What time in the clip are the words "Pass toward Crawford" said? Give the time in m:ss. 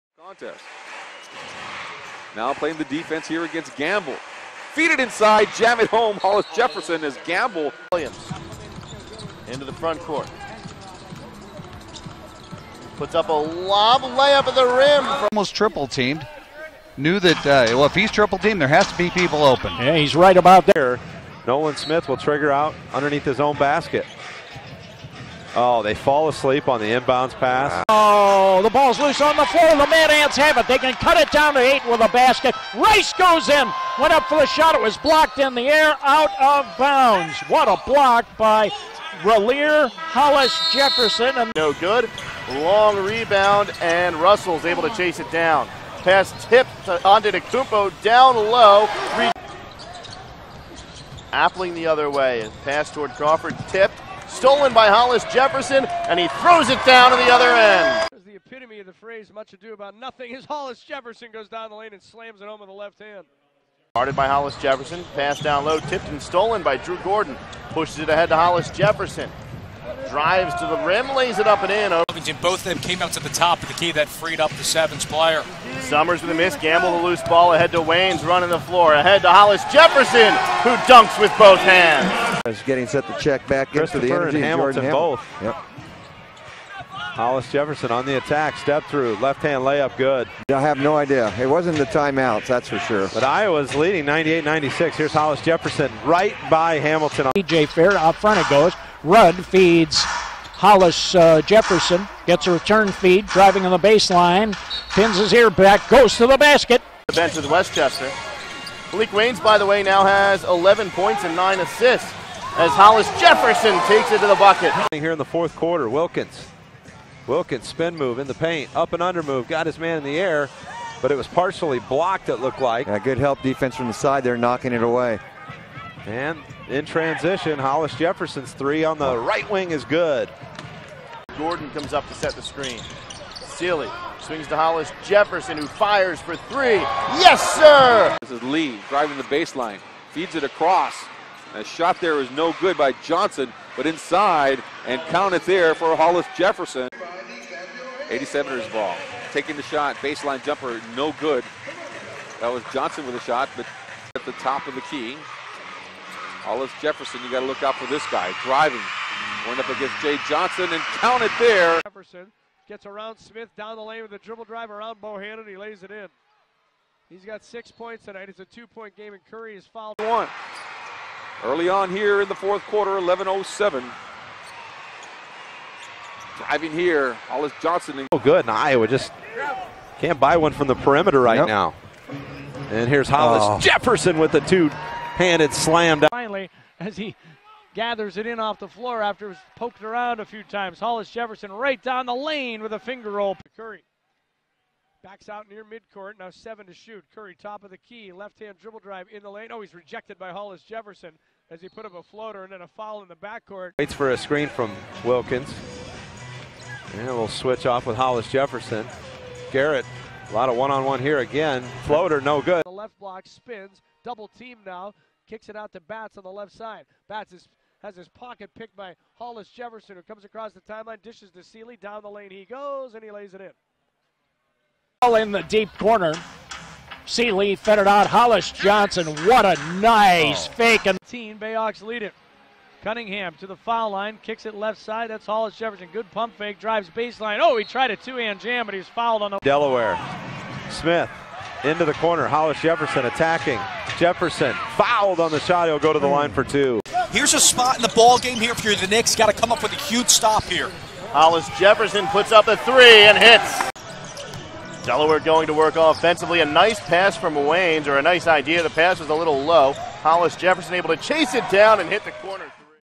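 0:52.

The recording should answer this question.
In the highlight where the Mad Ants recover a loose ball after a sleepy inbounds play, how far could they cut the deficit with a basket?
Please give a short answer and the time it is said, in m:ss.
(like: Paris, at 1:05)
8, at 0:31.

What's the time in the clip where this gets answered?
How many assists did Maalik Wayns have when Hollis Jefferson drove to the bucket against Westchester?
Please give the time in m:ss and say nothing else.
1:51.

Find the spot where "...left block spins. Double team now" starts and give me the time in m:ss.
3:32.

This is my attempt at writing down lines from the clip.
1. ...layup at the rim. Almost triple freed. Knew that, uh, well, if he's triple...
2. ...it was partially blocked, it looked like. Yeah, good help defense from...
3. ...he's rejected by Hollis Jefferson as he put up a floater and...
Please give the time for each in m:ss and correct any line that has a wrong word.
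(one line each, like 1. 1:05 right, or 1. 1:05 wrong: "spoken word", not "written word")
1. 0:14 wrong: "teamed", not "freed"
2. 2:01 right
3. 3:19 right.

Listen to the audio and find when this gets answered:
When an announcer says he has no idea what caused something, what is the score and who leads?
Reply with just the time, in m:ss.
1:34.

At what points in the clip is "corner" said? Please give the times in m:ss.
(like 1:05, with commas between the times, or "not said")
3:45, 4:01, 4:22.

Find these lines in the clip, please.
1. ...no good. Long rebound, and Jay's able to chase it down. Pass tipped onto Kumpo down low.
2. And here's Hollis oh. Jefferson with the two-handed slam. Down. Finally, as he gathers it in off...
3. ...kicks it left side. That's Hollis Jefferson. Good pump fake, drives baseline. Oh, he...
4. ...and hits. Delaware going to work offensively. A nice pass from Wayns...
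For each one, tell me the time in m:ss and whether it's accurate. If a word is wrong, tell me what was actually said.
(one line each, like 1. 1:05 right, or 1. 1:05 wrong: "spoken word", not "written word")
1. 0:41 wrong: "Russell", not "Jay"
2. 3:02 right
3. 3:54 right
4. 4:13 right.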